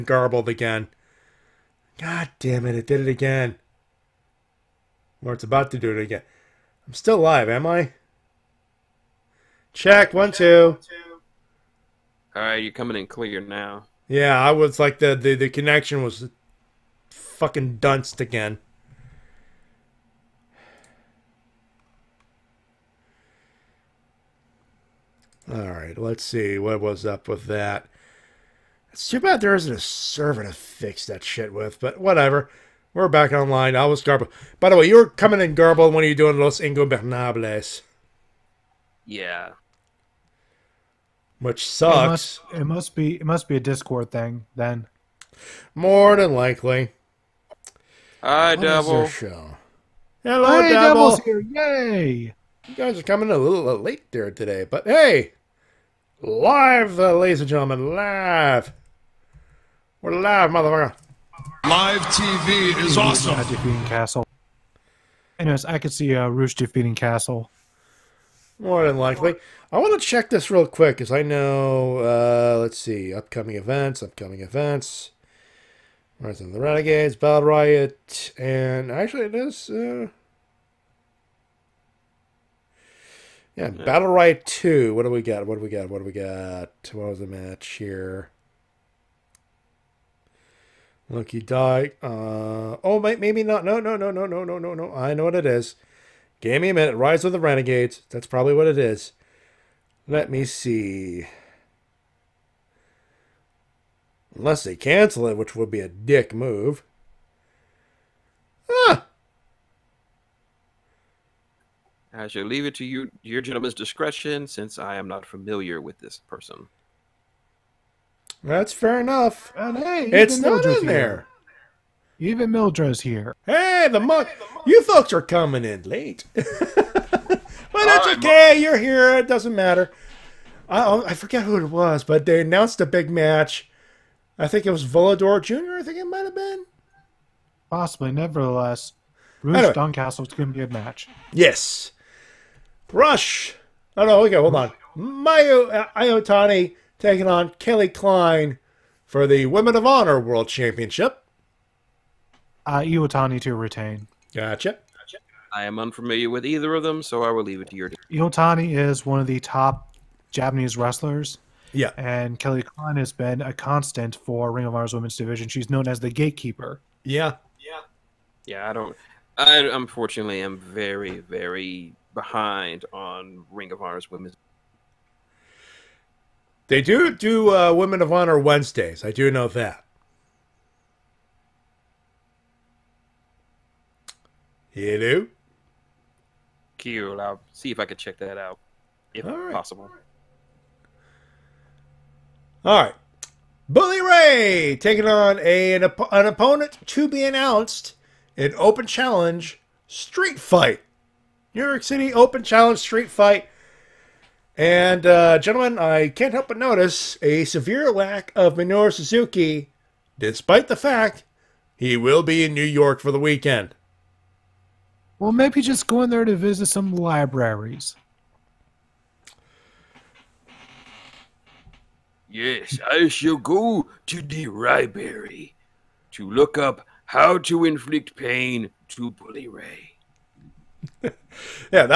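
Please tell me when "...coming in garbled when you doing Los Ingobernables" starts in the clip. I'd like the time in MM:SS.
00:35.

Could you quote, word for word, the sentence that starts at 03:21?
New York City Open Challenge Street Fight.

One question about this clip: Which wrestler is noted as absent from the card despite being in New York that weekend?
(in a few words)
Minoru Suzuki.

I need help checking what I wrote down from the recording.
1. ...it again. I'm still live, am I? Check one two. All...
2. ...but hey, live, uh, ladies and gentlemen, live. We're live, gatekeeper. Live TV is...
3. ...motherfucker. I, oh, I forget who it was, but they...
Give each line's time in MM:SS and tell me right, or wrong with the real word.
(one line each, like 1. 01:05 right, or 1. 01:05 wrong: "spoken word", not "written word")
1. 00:05 right
2. 00:54 wrong: "motherfucker", not "gatekeeper"
3. 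02:09 wrong: "matter", not "motherfucker".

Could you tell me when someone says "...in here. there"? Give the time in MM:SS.
02:00.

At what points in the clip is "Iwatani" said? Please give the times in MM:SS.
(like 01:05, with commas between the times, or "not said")
02:25, 02:32, 02:38.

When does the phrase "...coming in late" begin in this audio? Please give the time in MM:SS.
02:05.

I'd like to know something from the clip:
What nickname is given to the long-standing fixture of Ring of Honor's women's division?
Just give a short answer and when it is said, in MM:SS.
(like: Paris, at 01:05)
the gatekeeper, at 02:45.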